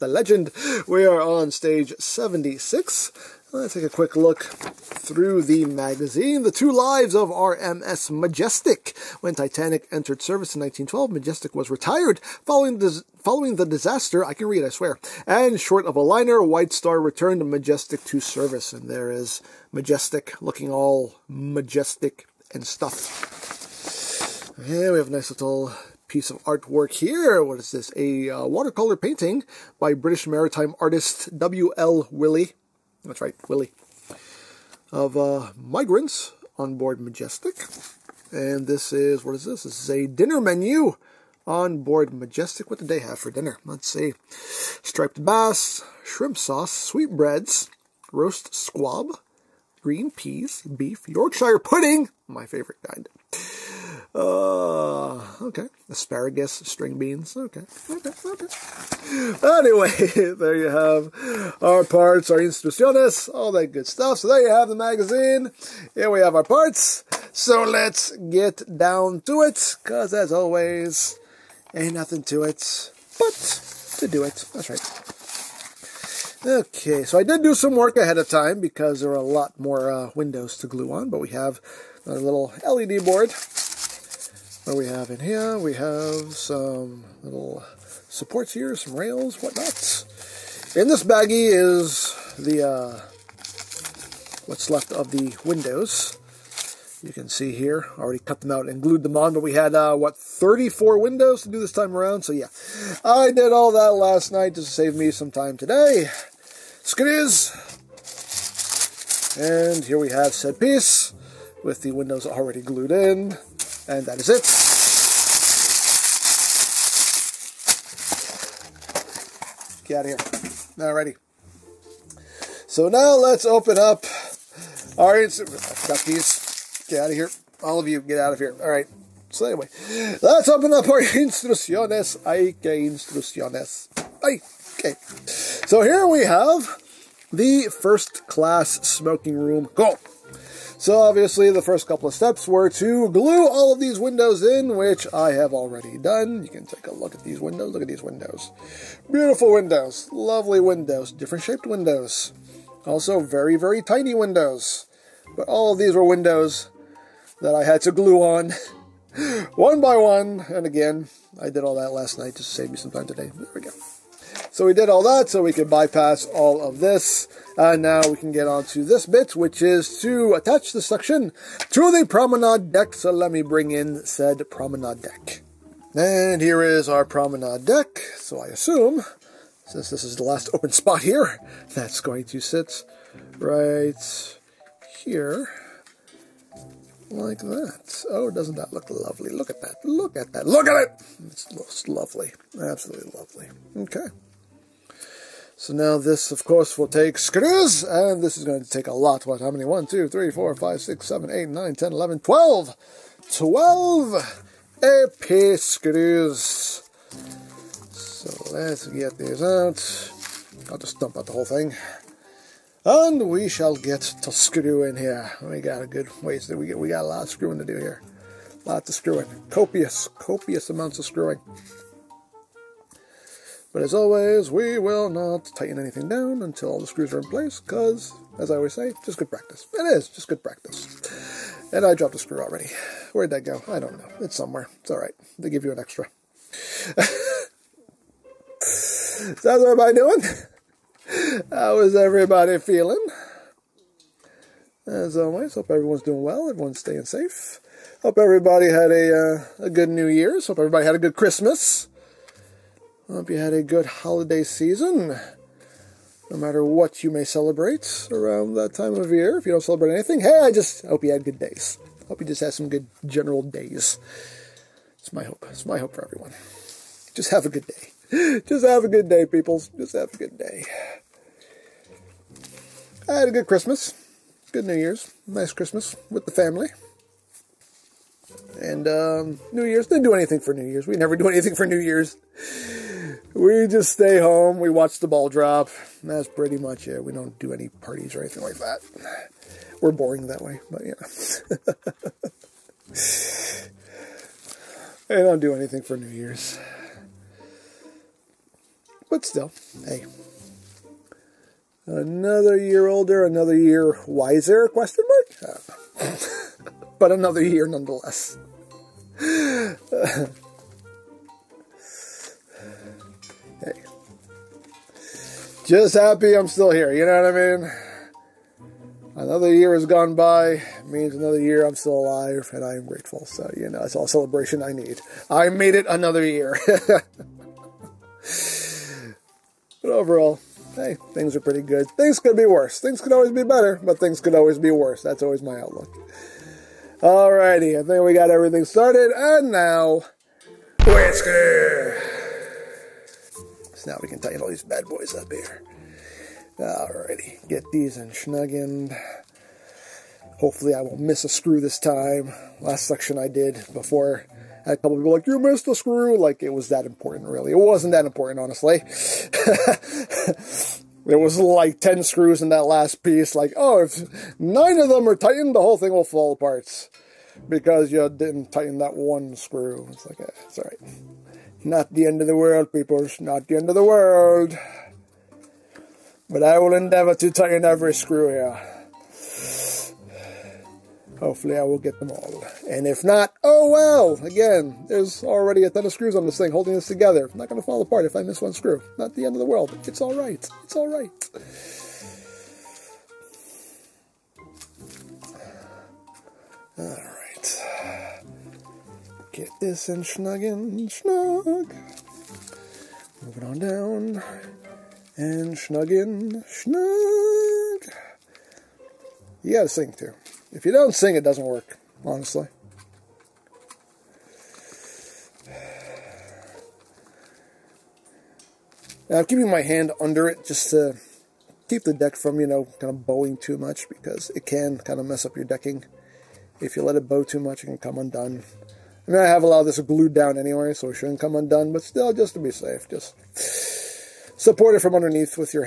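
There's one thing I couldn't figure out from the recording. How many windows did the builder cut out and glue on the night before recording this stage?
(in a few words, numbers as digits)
34.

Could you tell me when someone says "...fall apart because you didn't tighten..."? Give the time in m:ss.
6:06.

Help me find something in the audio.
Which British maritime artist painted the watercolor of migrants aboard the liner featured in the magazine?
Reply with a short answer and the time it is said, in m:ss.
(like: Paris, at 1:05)
W.L. Wyllie, at 0:31.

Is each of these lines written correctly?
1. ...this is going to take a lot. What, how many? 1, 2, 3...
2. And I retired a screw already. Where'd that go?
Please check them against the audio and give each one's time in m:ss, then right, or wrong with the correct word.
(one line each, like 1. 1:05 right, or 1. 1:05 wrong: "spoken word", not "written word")
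1. 3:18 right
2. 3:51 wrong: "dropped", not "retired".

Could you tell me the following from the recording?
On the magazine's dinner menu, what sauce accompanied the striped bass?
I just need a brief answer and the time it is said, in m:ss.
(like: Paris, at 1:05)
Shrimp sauce, at 0:46.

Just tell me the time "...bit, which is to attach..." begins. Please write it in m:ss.
2:49.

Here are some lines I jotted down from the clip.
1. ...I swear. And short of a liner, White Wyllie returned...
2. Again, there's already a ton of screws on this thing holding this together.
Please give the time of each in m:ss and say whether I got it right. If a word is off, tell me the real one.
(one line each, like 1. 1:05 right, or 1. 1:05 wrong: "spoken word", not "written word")
1. 0:14 wrong: "Star", not "Wyllie"
2. 6:24 right.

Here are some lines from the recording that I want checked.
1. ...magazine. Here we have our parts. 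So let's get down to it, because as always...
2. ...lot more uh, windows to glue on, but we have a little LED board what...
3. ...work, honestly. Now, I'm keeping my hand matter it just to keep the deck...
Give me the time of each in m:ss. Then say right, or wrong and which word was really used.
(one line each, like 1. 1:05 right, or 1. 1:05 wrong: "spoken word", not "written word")
1. 1:04 right
2. 1:19 right
3. 6:51 wrong: "under", not "matter".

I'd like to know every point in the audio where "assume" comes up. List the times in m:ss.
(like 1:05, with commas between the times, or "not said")
2:58.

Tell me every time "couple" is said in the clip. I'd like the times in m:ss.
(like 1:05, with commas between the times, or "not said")
2:21, 5:54.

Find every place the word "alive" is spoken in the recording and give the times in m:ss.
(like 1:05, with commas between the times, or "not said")
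5:21.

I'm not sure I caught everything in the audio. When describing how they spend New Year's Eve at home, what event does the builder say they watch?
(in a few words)
The ball drop.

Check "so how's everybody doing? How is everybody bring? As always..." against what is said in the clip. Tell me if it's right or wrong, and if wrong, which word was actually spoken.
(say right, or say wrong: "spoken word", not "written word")
wrong: "feeling", not "bring".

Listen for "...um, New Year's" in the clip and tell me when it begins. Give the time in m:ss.
4:38.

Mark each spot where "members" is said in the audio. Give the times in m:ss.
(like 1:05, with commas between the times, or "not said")
not said.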